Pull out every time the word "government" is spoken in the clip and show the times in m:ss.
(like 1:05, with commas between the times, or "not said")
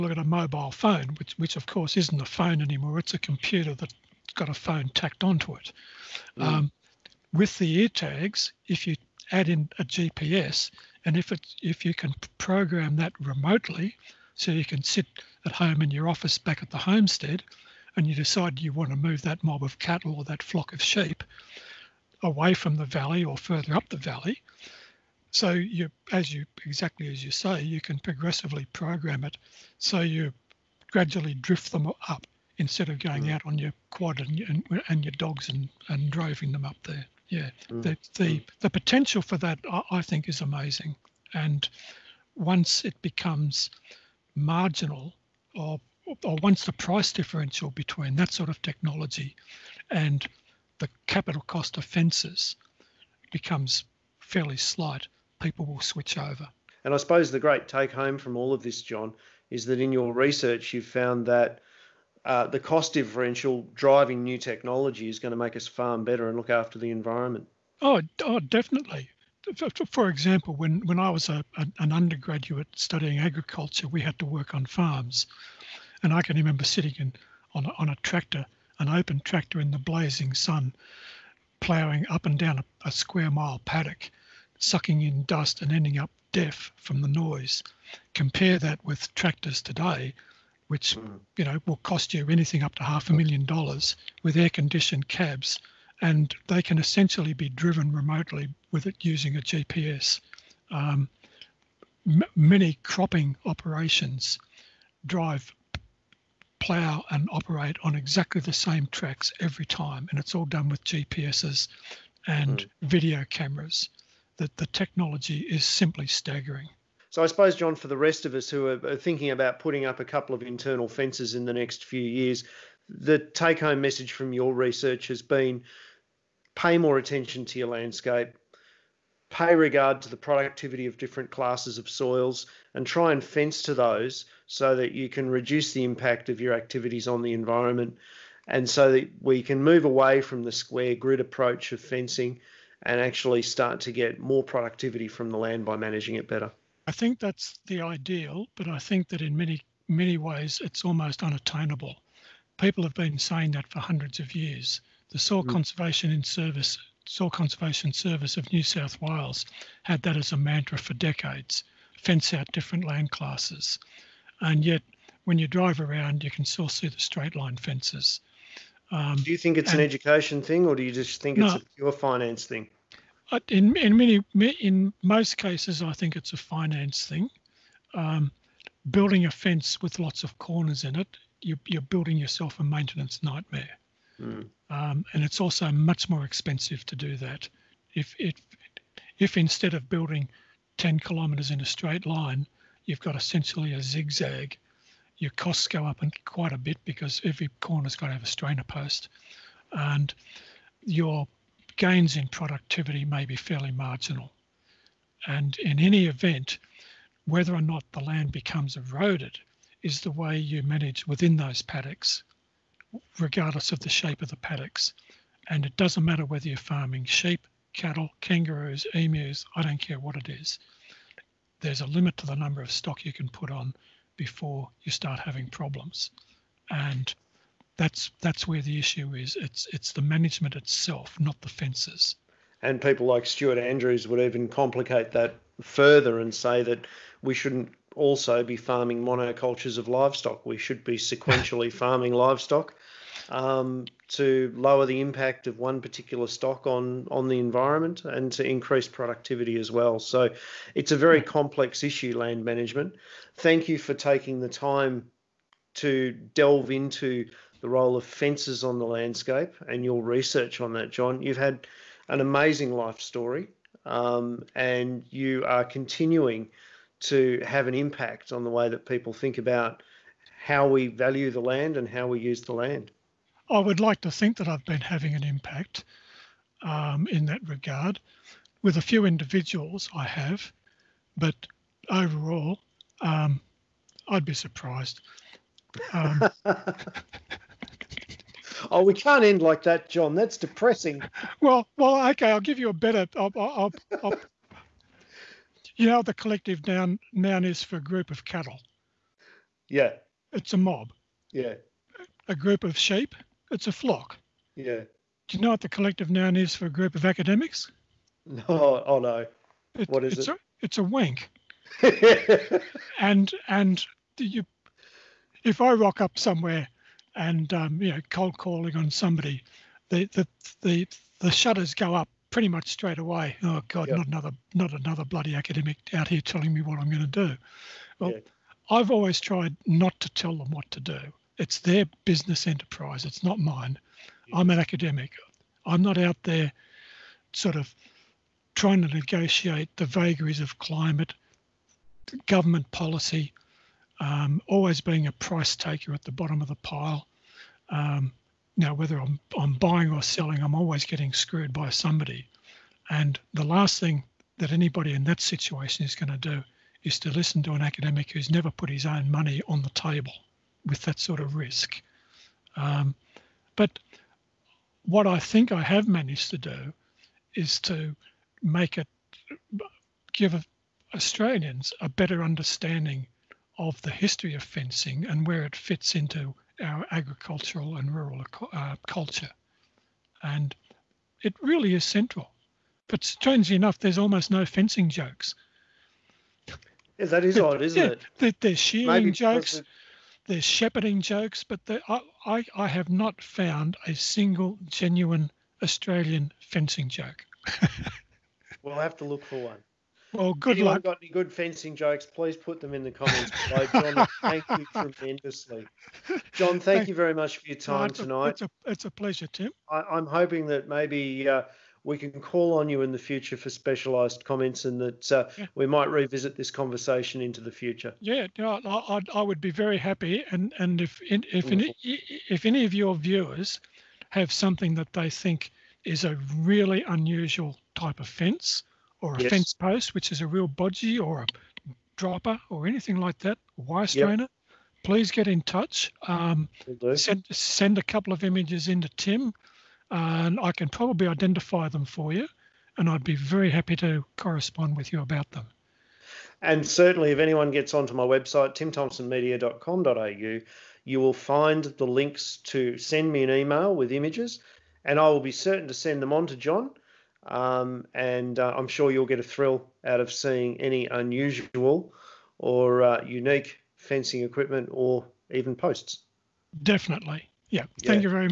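5:42.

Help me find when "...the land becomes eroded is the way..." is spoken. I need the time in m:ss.
3:27.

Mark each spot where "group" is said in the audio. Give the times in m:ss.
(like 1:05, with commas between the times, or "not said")
4:57, 5:02, 5:06.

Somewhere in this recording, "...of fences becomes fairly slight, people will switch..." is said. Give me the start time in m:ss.
0:51.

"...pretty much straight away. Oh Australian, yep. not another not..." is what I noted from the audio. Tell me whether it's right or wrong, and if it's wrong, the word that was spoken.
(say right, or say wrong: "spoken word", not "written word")
wrong: "God", not "Australian".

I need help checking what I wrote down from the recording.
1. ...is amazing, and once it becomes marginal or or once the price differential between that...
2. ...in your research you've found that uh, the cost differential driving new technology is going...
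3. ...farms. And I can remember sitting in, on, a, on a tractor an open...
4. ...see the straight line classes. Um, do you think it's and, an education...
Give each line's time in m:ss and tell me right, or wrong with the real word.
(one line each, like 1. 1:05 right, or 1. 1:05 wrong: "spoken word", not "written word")
1. 0:40 right
2. 0:59 right
3. 1:14 right
4. 2:46 wrong: "fences", not "classes".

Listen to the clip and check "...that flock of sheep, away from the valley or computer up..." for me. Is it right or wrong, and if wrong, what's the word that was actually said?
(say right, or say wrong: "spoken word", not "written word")
wrong: "further", not "computer".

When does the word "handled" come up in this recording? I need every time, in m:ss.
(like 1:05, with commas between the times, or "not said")
not said.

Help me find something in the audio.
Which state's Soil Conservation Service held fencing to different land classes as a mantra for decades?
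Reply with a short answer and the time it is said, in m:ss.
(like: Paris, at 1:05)
New South Wales, at 2:38.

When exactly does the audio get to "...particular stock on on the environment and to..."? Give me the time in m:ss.
4:05.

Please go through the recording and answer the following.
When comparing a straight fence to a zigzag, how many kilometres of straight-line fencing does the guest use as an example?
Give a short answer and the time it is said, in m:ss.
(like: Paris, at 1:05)
10, at 3:10.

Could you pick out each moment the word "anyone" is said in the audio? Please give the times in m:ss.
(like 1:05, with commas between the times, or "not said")
6:40, 7:27.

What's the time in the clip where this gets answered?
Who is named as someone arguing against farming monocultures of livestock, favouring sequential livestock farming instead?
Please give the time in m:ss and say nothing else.
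3:53.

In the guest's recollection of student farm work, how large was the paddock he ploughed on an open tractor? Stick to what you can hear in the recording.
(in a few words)
a square mile.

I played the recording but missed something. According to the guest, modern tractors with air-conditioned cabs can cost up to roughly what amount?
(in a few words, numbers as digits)
half a million dollars.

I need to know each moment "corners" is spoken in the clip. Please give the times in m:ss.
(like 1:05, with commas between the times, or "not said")
3:00, 3:17.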